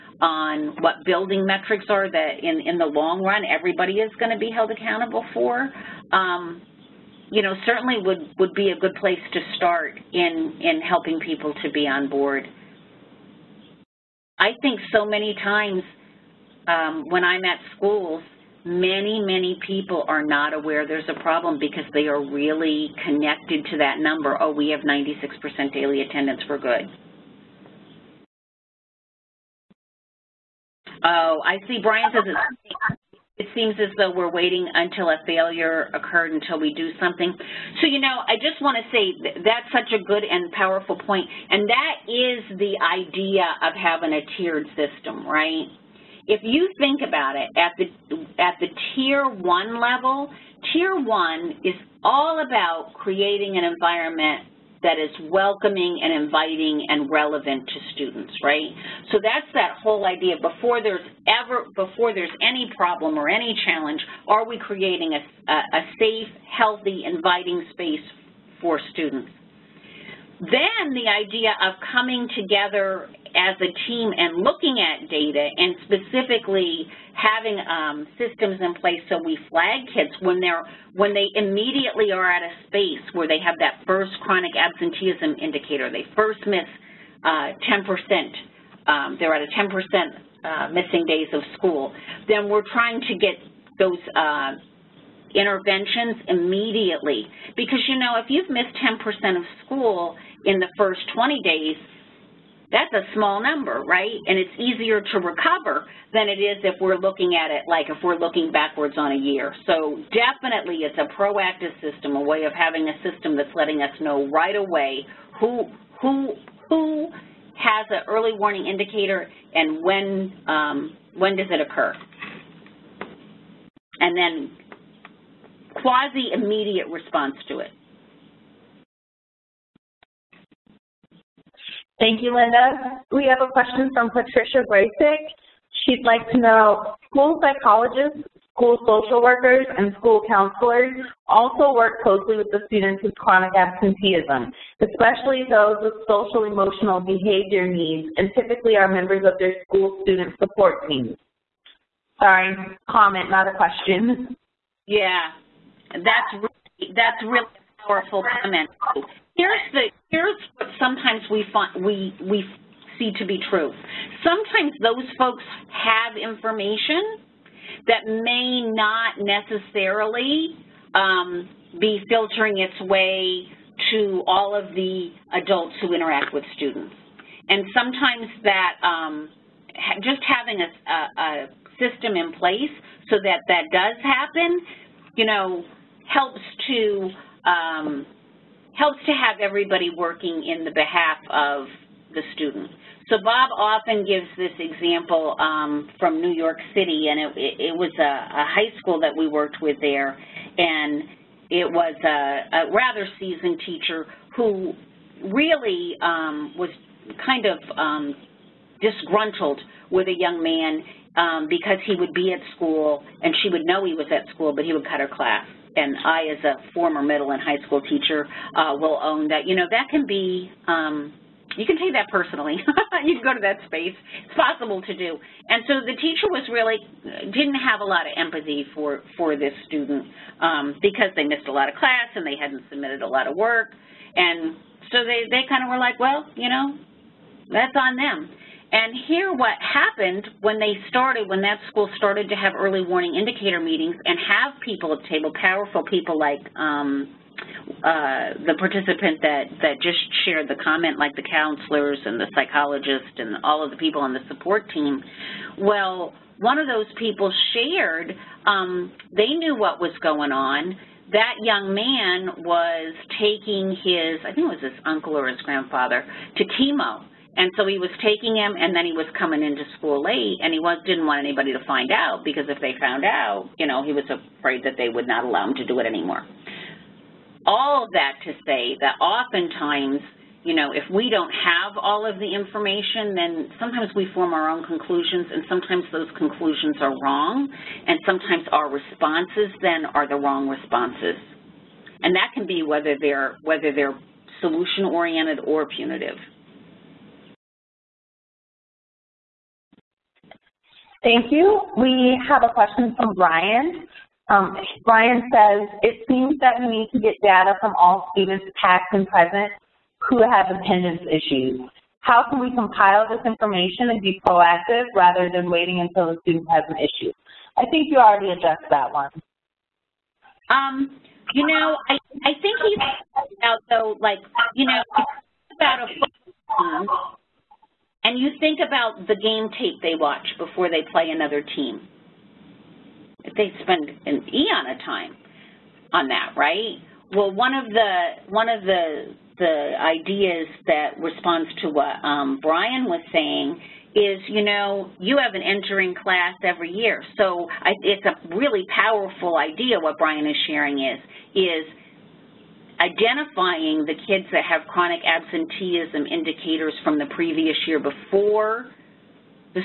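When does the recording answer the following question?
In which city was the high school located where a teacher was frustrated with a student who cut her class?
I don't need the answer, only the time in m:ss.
3:16.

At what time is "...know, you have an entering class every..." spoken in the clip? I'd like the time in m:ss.
5:44.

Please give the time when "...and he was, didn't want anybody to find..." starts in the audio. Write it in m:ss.
4:30.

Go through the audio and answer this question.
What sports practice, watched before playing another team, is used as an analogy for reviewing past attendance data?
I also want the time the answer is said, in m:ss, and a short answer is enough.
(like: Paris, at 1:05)
game tape, at 5:29.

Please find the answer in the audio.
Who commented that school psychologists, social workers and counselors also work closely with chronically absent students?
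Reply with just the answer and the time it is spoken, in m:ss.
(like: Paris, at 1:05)
Patricia Gracek, at 2:14.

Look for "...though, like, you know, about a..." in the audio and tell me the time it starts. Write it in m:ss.
5:23.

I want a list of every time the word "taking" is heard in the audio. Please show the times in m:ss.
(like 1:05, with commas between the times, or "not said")
4:23, 4:28.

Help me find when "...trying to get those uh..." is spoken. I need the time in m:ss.
1:32.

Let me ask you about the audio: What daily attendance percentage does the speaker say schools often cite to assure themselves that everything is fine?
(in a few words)
96%.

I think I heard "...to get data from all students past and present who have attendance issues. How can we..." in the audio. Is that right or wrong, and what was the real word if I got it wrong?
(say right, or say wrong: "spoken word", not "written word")
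right.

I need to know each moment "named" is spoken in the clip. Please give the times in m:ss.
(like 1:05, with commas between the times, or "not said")
not said.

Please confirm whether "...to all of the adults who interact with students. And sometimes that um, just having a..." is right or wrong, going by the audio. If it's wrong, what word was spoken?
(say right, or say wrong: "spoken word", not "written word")
right.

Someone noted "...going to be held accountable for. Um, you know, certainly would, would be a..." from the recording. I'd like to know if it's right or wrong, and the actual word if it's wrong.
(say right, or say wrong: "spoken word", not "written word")
right.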